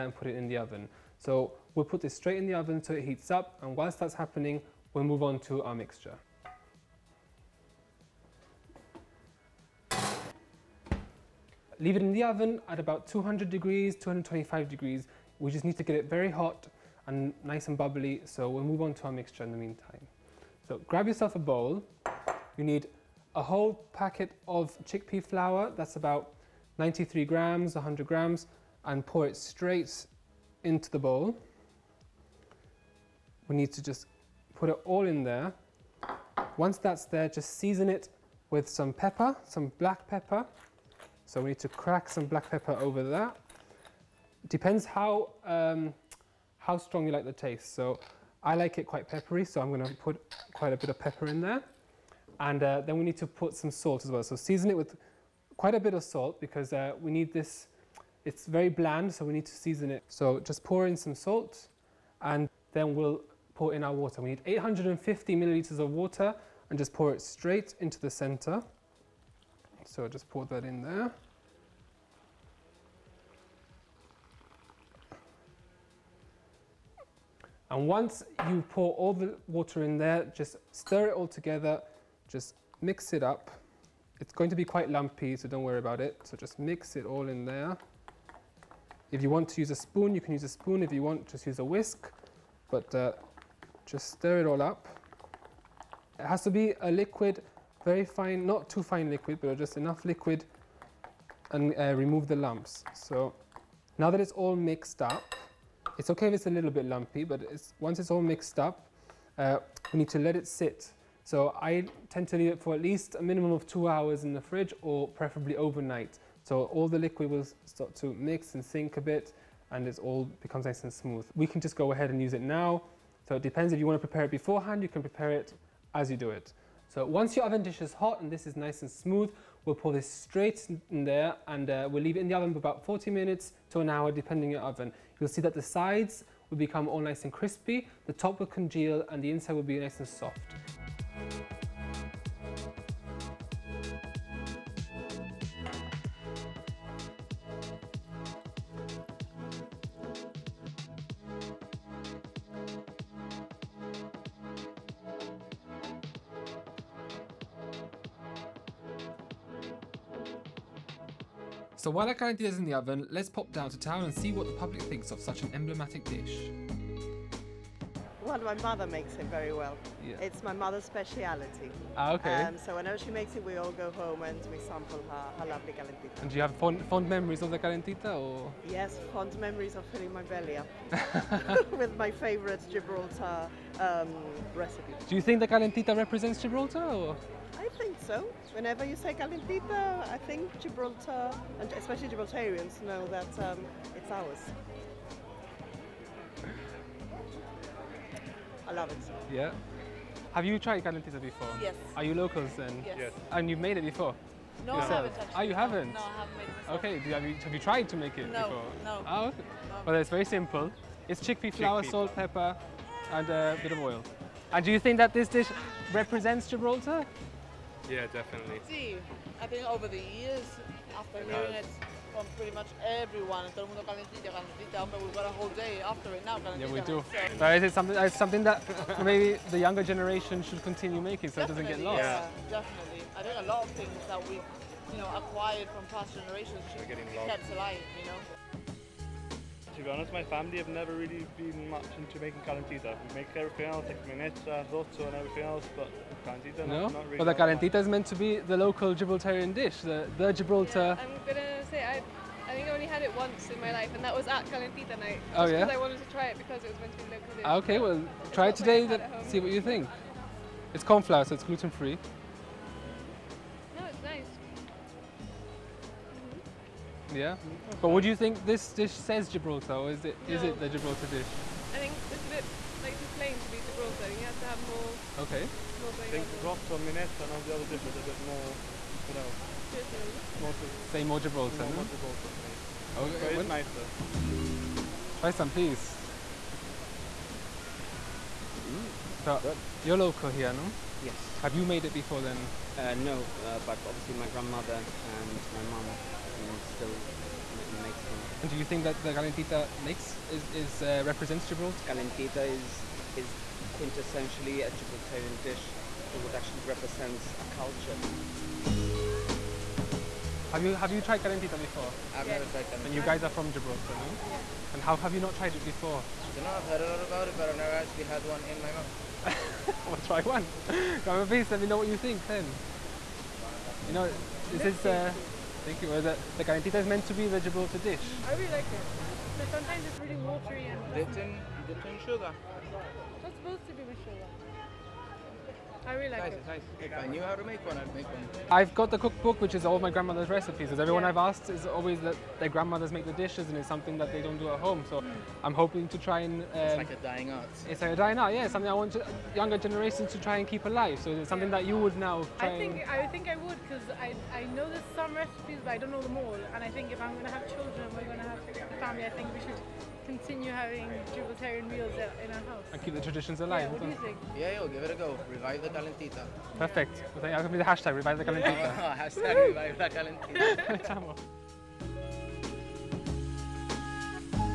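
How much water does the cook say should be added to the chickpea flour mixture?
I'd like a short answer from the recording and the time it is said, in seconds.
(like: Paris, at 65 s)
850 milliliters, at 64 s.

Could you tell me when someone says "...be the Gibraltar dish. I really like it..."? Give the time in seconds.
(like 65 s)
327 s.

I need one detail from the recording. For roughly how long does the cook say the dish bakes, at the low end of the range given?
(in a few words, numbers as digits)
40 minutes.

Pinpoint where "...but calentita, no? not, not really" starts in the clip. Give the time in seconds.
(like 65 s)
245 s.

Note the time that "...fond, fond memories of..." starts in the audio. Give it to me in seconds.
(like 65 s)
176 s.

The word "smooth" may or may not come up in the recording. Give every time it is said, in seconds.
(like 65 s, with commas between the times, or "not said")
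120 s, 128 s.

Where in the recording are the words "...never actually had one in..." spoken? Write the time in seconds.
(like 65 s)
317 s.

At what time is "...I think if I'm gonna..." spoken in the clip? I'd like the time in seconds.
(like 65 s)
356 s.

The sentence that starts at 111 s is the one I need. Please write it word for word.
So I tend to leave it for at least a minimum of two hours in the fridge or preferably overnight.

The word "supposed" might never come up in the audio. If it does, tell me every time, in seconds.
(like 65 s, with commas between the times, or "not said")
333 s.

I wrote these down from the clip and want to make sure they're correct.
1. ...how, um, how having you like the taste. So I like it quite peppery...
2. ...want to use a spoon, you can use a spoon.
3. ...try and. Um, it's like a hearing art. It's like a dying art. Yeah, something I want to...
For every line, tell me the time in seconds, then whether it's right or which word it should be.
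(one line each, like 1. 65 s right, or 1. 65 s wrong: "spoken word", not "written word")
1. 44 s wrong: "strong", not "having"
2. 89 s right
3. 345 s wrong: "dying", not "hearing".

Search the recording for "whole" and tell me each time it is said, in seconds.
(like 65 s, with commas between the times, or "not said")
23 s, 225 s.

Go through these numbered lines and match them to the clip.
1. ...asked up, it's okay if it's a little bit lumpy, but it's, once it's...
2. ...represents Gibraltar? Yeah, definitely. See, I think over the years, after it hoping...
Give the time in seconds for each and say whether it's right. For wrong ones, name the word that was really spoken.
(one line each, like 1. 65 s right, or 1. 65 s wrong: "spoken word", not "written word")
1. 104 s wrong: "mixed", not "asked"
2. 215 s wrong: "hearing", not "hoping".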